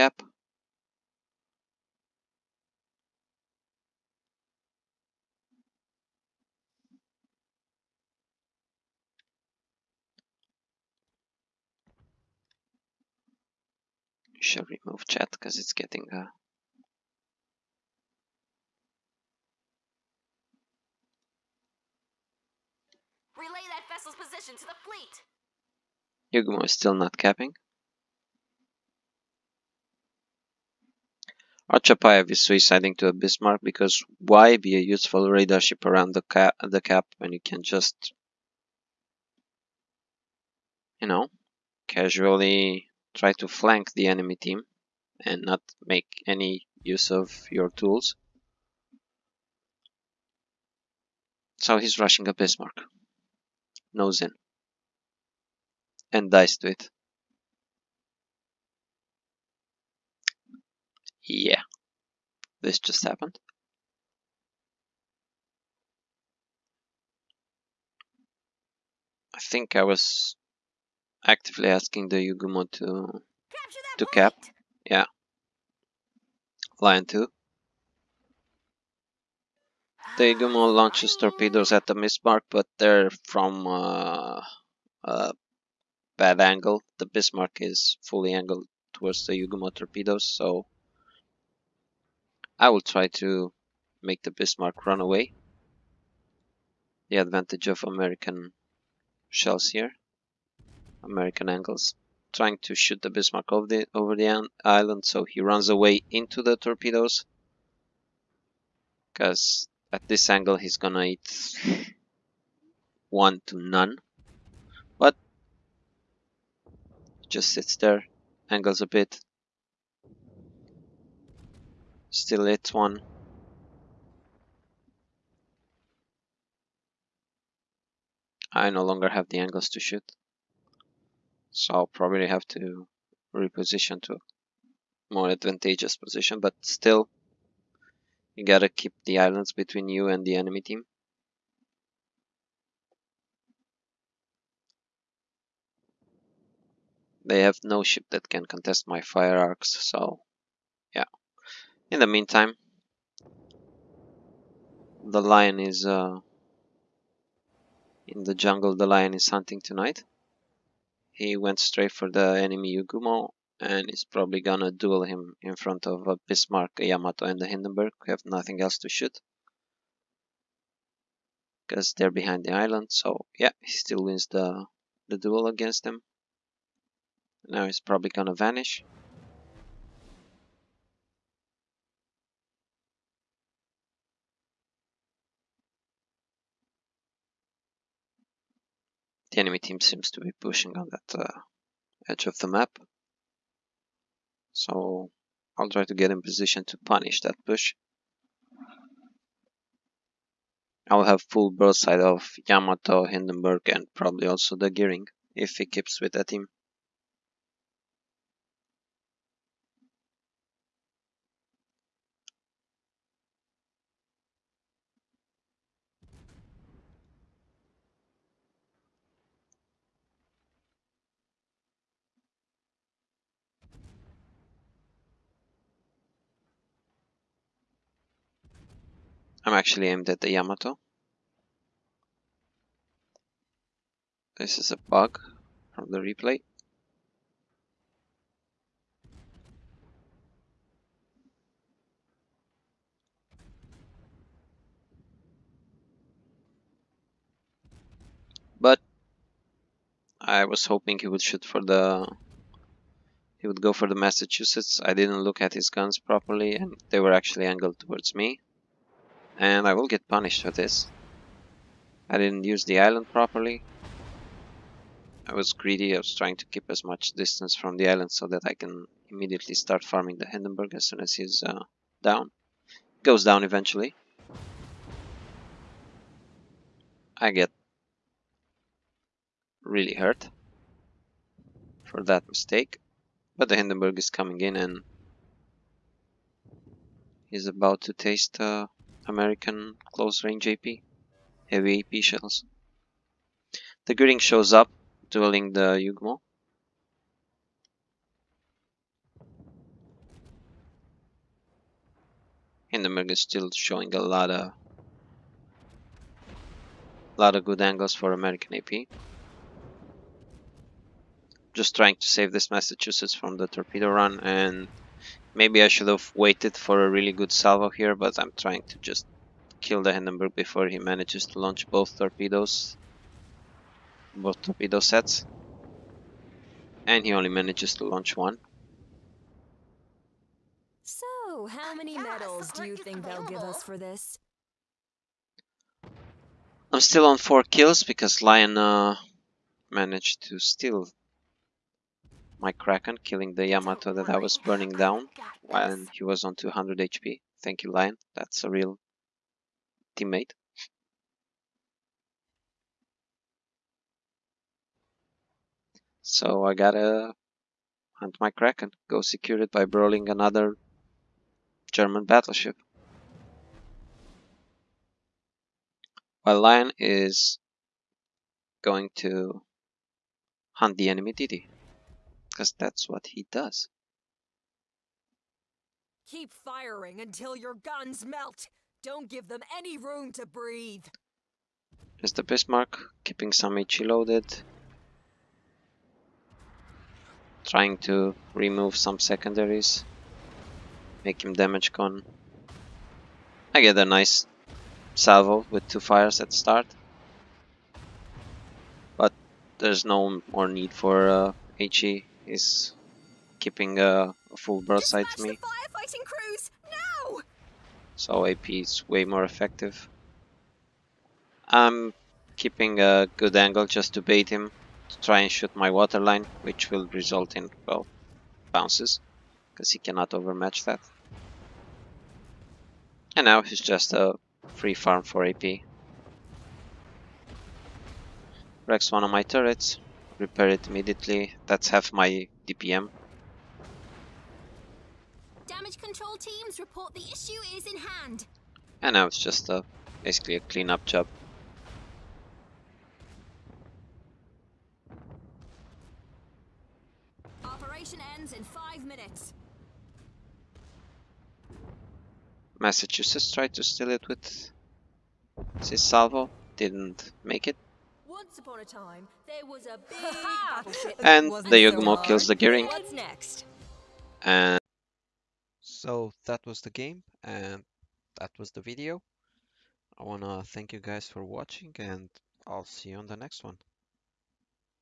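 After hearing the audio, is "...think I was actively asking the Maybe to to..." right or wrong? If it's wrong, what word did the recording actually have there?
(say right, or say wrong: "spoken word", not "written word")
wrong: "Yugumo", not "Maybe".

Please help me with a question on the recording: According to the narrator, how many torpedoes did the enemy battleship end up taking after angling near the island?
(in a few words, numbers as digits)
1.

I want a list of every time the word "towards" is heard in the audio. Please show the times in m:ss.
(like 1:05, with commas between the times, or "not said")
1:28, 4:17.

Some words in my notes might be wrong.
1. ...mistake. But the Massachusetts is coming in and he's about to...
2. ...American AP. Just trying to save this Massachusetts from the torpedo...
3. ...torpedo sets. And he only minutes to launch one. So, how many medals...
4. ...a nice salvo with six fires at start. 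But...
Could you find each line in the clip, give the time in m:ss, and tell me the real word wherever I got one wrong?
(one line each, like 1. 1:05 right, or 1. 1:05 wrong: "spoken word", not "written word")
1. 4:42 wrong: "Hindenburg", not "Massachusetts"
2. 5:08 right
3. 5:24 wrong: "manages", not "minutes"
4. 6:33 wrong: "two", not "six".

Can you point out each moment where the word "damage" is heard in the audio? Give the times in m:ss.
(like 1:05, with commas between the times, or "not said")
6:31, 7:15.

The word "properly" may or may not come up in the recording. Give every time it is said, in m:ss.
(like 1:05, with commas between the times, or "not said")
4:15, 4:23.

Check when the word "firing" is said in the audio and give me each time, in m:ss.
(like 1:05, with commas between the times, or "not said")
6:16.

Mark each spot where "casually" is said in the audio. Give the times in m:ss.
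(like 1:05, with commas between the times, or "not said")
0:41.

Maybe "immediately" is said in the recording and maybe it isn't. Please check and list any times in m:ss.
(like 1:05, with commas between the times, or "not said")
4:29, 7:10.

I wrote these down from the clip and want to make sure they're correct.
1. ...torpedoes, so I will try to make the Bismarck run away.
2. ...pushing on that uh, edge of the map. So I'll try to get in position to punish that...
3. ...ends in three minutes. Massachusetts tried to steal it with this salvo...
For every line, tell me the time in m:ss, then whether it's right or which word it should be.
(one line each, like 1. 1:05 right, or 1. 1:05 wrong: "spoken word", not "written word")
1. 1:29 right
2. 3:10 right
3. 7:28 wrong: "five", not "three".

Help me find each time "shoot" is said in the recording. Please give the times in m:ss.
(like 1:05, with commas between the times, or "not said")
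1:42, 2:09, 2:48, 4:11, 6:55.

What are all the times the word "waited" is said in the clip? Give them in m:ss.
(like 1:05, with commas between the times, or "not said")
5:16.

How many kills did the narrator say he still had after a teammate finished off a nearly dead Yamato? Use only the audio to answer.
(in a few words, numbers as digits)
4.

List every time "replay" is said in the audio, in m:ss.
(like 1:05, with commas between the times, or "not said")
3:55.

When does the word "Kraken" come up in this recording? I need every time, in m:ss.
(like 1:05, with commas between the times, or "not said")
5:42, 5:58.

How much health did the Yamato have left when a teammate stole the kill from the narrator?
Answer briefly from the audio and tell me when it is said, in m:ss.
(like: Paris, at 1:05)
200 HP, at 5:46.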